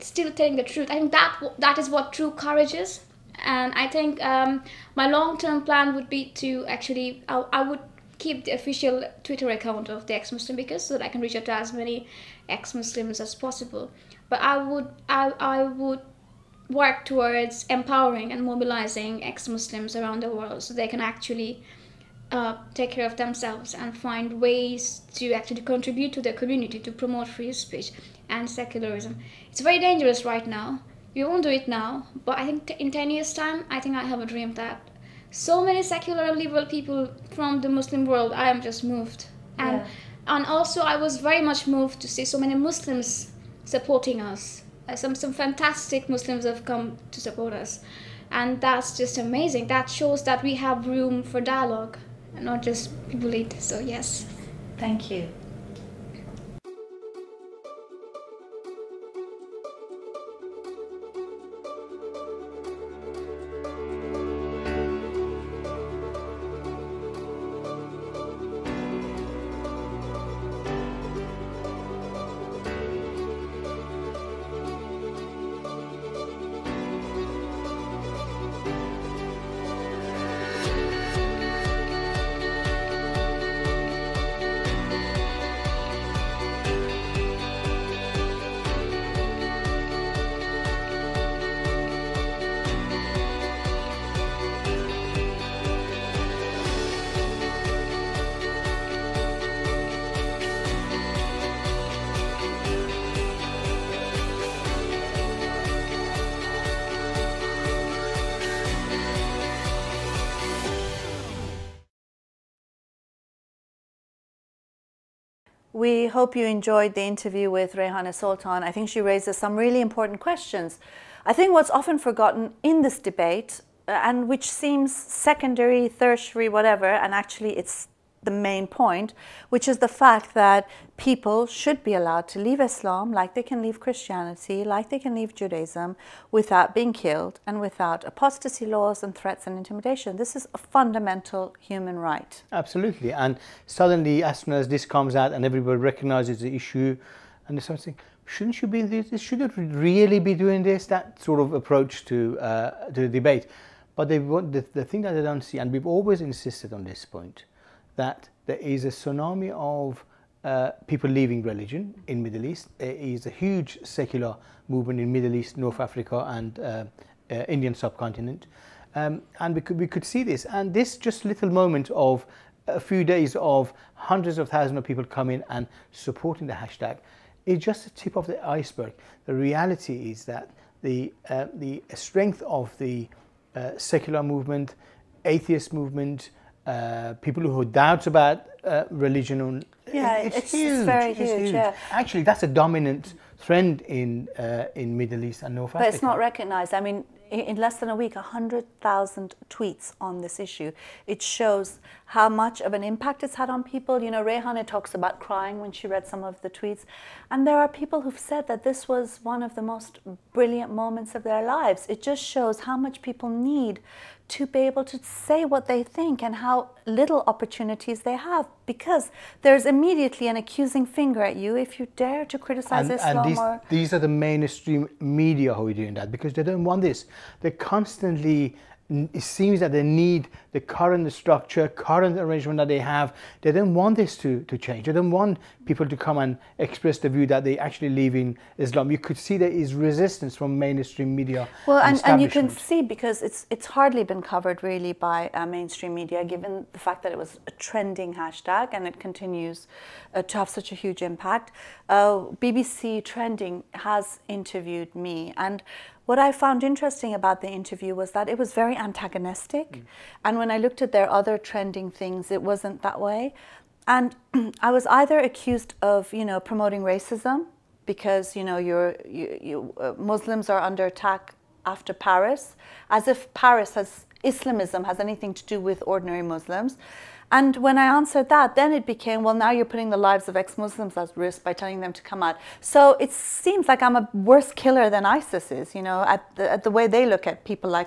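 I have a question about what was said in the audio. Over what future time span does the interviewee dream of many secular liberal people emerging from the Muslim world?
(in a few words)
10 years.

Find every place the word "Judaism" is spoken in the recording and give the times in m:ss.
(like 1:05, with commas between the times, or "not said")
2:15.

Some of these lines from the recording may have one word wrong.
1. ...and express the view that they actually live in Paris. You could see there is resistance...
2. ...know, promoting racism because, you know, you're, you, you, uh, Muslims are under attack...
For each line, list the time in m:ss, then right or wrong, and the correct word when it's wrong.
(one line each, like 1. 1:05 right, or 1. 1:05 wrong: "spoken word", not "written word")
1. 3:56 wrong: "Islam", not "Paris"
2. 4:26 right.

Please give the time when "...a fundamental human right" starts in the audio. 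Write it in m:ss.
2:20.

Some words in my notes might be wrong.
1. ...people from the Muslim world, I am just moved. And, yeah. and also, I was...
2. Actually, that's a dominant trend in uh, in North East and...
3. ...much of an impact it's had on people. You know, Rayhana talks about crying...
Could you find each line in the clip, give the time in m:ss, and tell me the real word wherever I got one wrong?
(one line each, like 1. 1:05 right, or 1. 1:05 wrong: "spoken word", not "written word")
1. 0:36 right
2. 3:11 wrong: "Middle", not "North"
3. 3:22 right.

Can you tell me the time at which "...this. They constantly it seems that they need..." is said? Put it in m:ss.
3:46.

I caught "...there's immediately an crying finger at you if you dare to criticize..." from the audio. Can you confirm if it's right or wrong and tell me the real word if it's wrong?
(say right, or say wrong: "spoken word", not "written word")
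wrong: "accusing", not "crying".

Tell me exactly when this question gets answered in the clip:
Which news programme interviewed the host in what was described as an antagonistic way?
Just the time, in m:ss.
4:12.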